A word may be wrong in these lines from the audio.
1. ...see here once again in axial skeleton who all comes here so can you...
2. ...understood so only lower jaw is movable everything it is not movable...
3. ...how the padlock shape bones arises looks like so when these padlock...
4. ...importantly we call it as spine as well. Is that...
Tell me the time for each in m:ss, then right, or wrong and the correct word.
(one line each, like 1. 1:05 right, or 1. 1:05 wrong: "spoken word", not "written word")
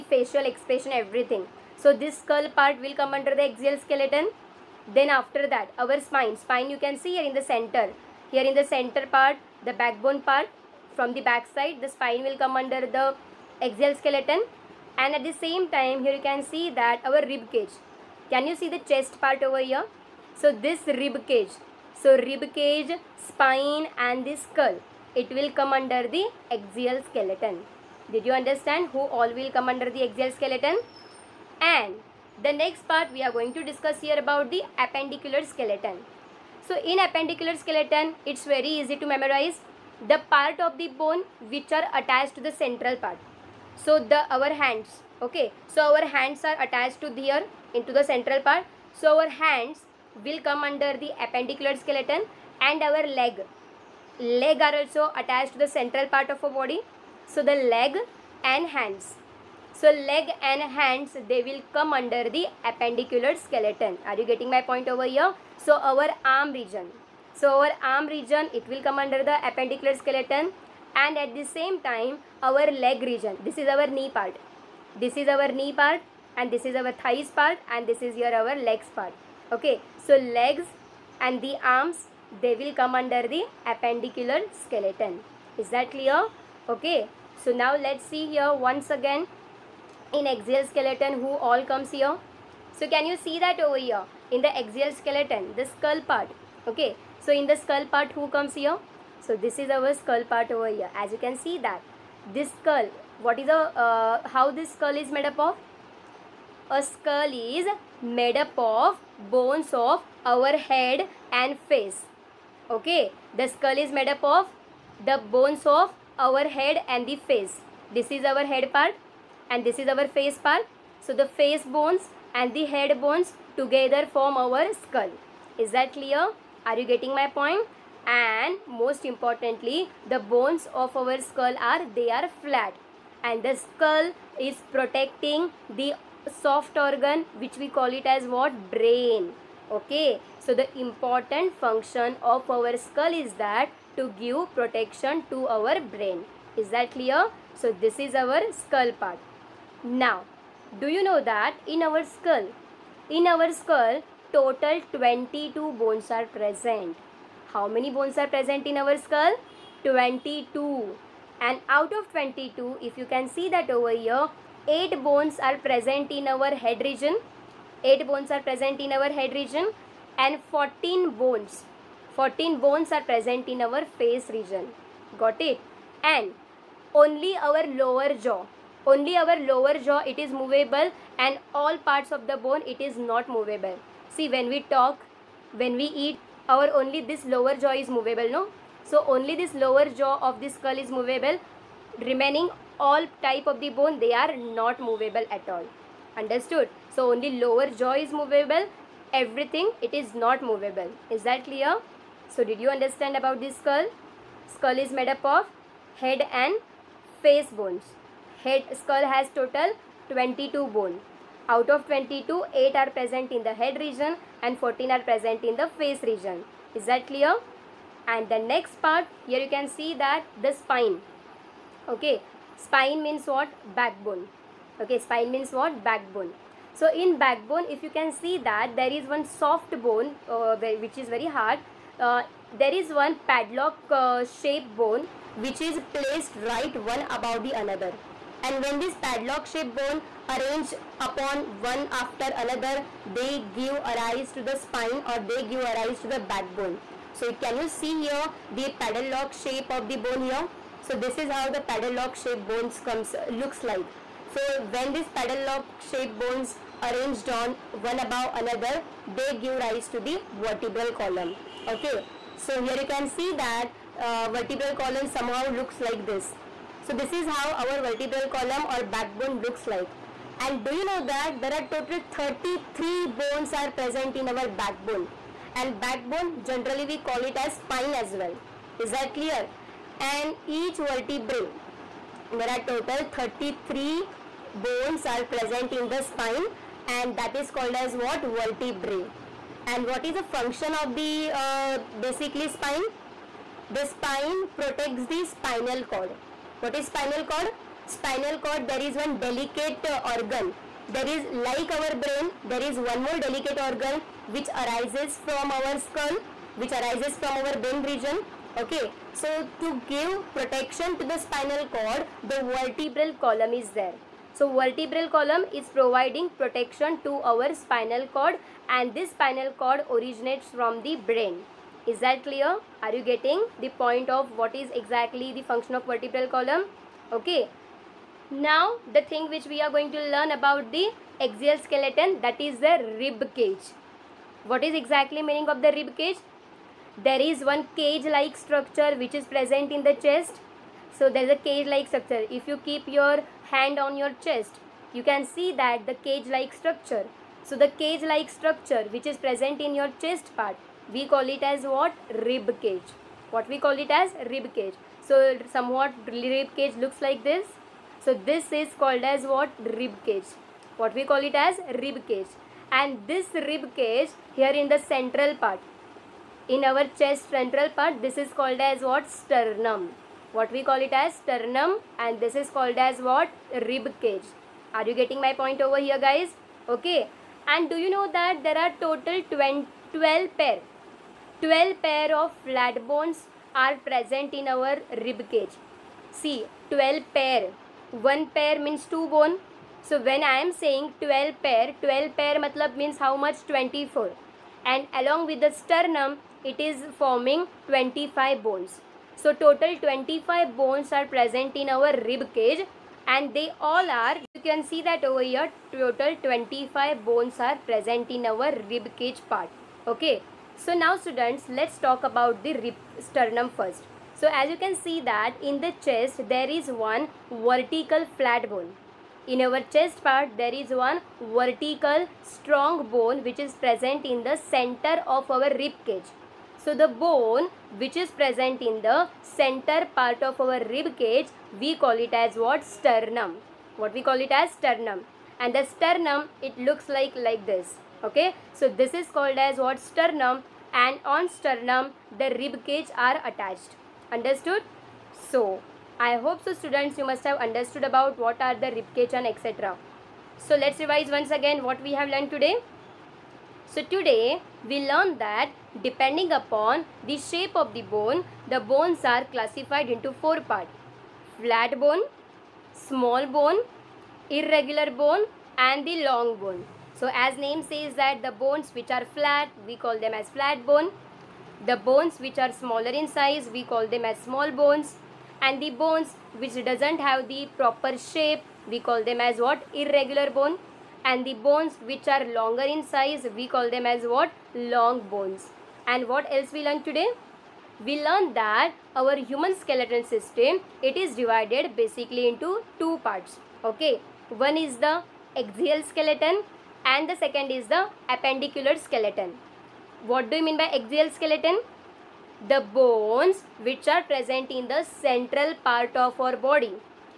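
1. 1:28 right
2. 3:16 right
3. 4:11 wrong: "comes", not "arises"
4. 4:36 wrong: "generally", not "importantly".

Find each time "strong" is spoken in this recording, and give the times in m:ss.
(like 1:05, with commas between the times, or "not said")
7:02.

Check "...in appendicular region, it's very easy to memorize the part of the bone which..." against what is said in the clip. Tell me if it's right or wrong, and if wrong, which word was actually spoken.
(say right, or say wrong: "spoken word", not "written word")
wrong: "skeleton", not "region".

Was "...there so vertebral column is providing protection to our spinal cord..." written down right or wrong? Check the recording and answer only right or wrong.
right.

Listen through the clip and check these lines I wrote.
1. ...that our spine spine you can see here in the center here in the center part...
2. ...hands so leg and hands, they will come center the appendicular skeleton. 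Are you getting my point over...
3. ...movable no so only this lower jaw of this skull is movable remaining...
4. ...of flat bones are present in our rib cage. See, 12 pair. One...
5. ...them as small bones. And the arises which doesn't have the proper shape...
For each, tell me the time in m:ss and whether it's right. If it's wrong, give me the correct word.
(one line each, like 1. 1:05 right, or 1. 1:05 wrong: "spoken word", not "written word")
1. 0:05 right
2. 0:58 wrong: "under", not "center"
3. 3:07 right
4. 6:22 right
5. 7:53 wrong: "bones", not "arises".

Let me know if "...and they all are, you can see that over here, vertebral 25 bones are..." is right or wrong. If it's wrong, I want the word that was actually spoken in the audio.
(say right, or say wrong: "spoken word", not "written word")
wrong: "total", not "vertebral".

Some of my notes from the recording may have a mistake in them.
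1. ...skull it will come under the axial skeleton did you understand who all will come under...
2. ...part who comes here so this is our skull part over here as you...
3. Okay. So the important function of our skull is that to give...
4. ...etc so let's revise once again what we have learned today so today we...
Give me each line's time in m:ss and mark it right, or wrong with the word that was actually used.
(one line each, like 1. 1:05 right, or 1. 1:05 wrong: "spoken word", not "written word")
1. 0:24 right
2. 1:37 right
3. 2:19 right
4. 7:29 right.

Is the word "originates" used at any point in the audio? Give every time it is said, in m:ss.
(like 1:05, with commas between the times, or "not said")
5:19.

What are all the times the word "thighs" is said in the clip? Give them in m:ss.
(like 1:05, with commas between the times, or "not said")
1:16.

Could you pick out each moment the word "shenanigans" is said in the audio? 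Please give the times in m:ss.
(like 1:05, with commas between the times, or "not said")
not said.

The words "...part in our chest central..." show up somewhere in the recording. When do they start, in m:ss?
6:05.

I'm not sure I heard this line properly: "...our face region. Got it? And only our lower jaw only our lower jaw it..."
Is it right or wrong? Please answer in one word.
right.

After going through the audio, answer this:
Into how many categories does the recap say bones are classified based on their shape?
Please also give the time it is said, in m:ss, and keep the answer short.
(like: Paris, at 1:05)
4, at 7:40.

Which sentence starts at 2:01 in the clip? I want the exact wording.
So the face bones and the head bones together form our skull.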